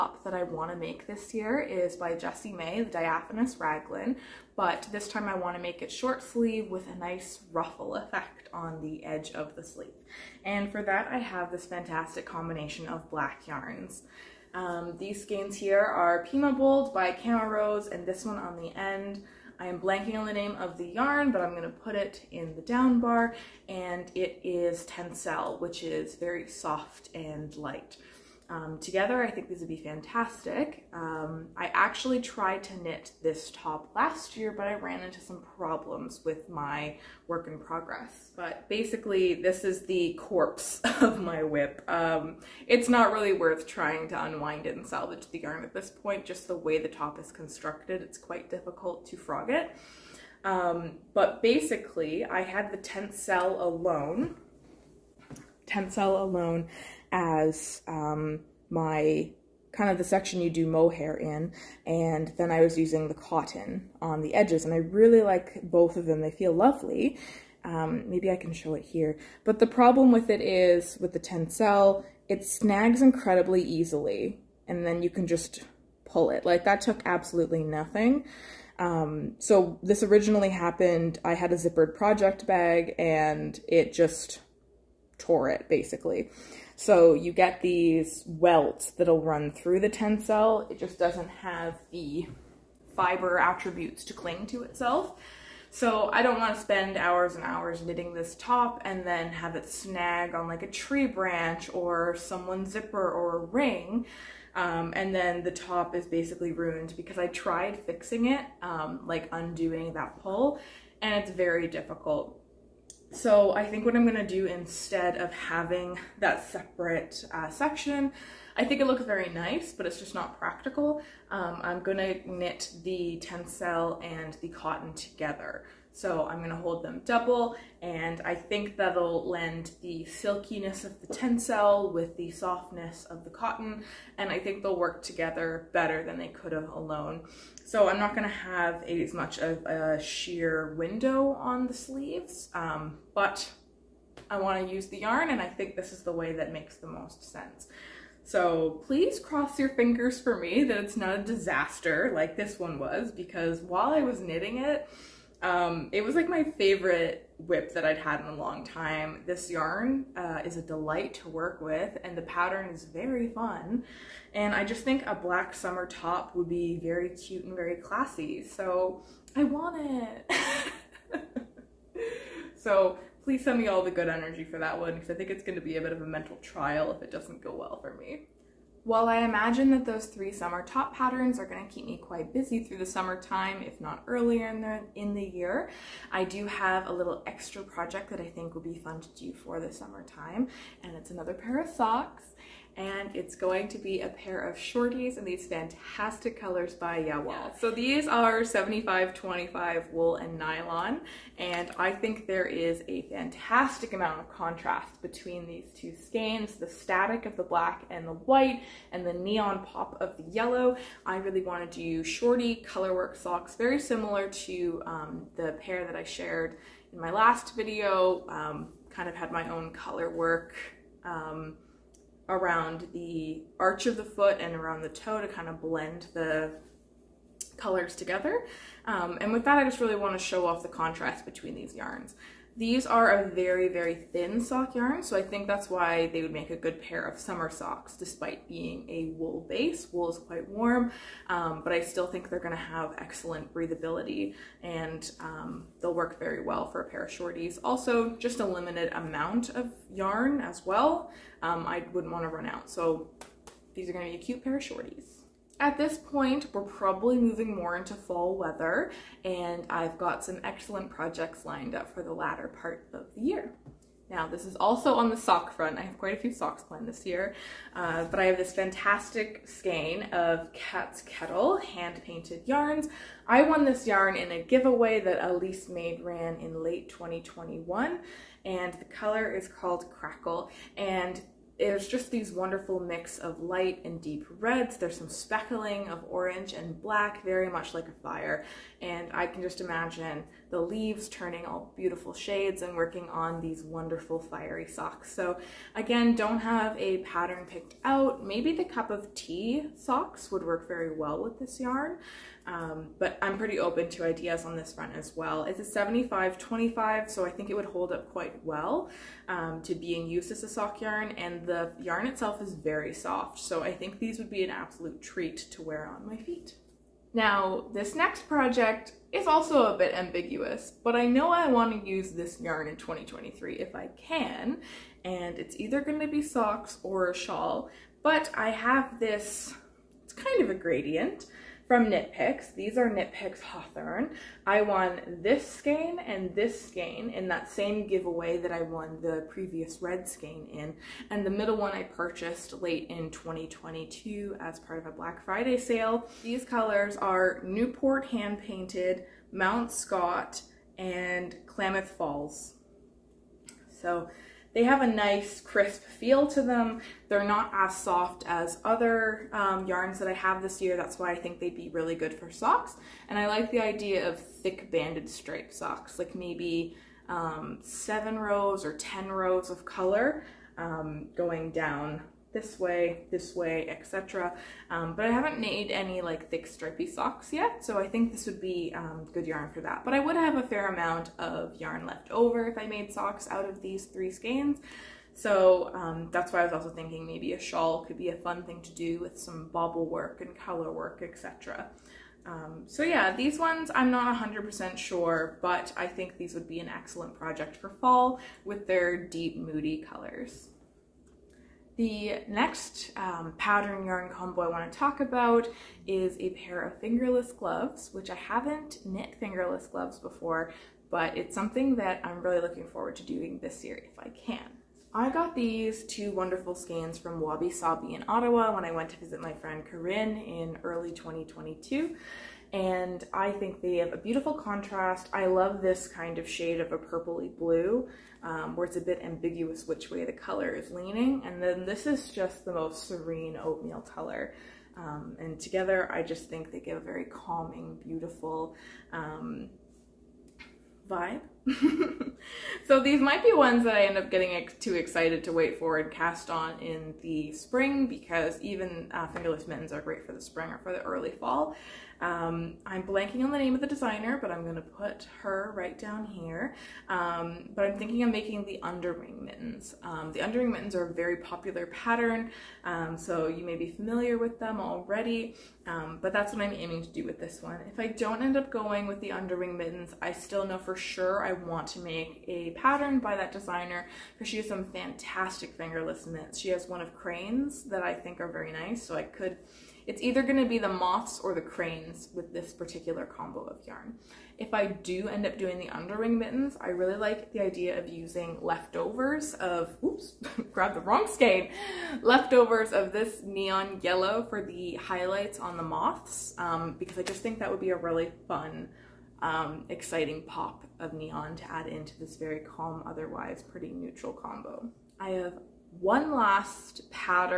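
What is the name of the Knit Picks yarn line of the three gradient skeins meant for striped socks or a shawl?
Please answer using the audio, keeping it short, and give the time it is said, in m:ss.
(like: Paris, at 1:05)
Hawthorne, at 5:33.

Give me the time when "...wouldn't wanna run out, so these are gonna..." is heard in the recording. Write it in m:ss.
4:11.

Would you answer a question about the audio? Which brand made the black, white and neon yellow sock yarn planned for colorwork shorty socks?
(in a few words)
Jawoll.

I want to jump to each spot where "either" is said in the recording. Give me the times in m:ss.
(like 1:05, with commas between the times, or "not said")
5:25, 8:00.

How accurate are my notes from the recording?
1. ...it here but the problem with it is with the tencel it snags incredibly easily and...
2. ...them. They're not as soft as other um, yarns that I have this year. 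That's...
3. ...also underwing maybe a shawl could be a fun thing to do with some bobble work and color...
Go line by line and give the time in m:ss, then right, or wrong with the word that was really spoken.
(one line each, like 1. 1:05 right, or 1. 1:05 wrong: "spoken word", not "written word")
1. 1:08 right
2. 5:56 right
3. 6:26 wrong: "thinking", not "underwing".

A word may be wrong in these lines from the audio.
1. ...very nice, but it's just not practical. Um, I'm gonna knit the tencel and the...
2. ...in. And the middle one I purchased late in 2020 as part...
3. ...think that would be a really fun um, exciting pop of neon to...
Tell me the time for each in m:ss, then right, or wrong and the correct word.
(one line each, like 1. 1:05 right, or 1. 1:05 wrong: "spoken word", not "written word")
1. 1:59 right
2. 5:40 wrong: "2022", not "2020"
3. 8:17 right.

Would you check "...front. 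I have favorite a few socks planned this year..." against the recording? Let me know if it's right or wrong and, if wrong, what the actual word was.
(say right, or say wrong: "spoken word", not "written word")
wrong: "quite", not "favorite".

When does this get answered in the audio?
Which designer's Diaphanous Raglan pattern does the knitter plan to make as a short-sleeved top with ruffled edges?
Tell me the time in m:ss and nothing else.
0:02.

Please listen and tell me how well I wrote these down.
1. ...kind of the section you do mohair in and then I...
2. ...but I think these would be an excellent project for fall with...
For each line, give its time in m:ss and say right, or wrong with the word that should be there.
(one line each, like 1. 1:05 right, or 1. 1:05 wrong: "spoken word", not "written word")
1. 0:59 right
2. 6:35 right.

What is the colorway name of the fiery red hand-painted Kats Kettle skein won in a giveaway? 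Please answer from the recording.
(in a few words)
Crackle.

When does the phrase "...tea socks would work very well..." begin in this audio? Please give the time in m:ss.
4:59.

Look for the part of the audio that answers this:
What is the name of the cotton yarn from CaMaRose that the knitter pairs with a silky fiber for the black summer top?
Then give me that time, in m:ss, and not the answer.
0:16.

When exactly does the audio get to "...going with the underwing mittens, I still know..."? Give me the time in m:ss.
7:48.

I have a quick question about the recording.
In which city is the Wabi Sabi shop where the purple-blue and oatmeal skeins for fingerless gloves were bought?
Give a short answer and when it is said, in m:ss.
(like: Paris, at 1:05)
Ottawa, at 6:58.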